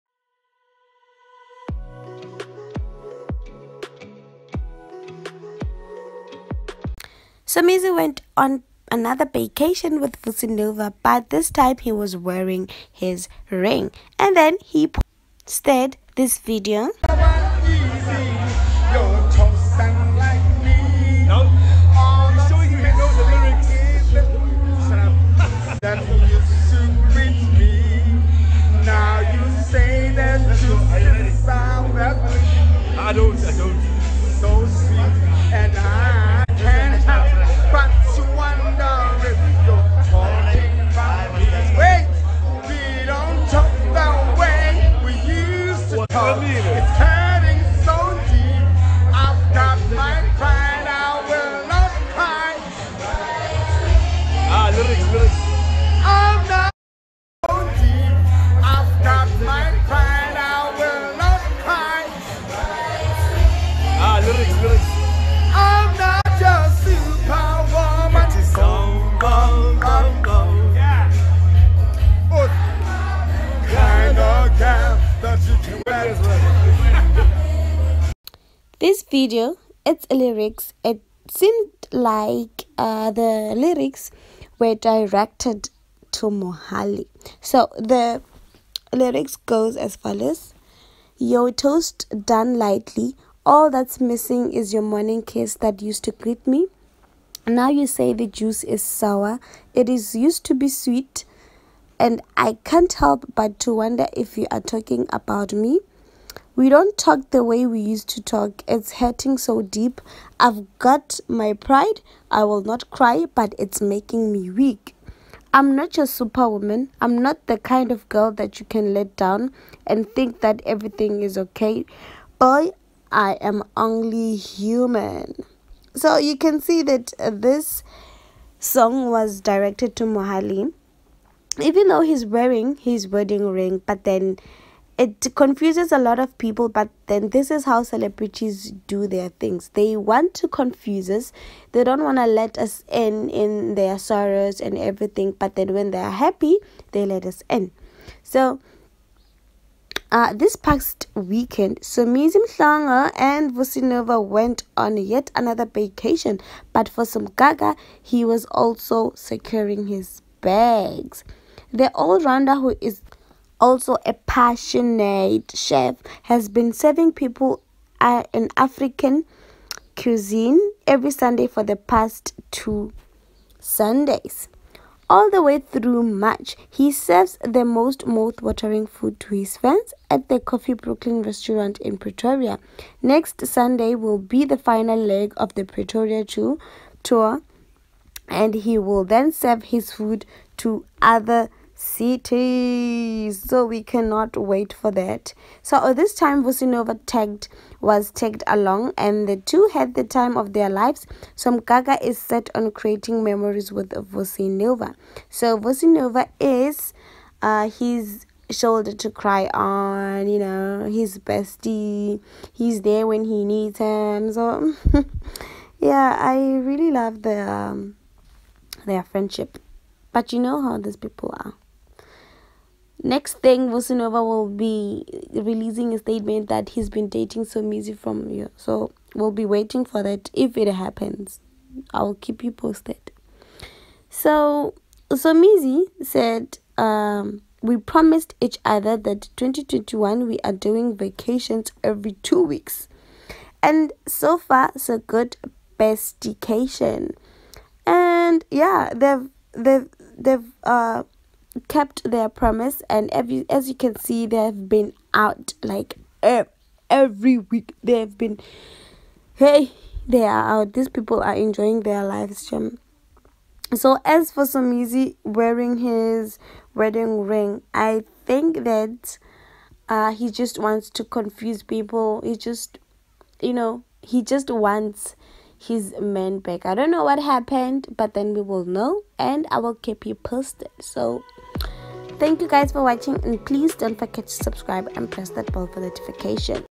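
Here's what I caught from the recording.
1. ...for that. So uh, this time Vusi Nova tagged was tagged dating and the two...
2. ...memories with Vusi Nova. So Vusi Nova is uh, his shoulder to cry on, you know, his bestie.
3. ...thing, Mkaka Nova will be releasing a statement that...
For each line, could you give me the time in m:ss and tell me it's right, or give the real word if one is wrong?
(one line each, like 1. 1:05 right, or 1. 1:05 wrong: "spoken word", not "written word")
1. 3:14 wrong: "along", not "dating"
2. 3:23 right
3. 3:43 wrong: "Vusi", not "Mkaka".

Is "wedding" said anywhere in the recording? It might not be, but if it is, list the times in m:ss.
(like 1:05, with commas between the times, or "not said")
2:13, 4:26.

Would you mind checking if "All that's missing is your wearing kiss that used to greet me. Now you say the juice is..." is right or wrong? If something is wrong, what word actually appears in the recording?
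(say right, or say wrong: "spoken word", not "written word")
wrong: "morning", not "wearing".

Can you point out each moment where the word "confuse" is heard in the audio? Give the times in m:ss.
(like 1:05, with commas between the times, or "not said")
2:15, 2:20, 4:31.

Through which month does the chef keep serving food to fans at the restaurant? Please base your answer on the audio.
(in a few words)
March.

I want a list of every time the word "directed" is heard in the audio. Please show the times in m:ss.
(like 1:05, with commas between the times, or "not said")
1:24, 2:09.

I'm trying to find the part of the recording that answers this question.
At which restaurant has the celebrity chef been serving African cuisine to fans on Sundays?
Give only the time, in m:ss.
3:00.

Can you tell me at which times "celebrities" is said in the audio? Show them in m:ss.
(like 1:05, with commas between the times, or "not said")
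2:17.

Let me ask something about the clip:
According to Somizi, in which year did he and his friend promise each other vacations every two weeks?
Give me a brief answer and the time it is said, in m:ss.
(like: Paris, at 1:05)
2021, at 3:59.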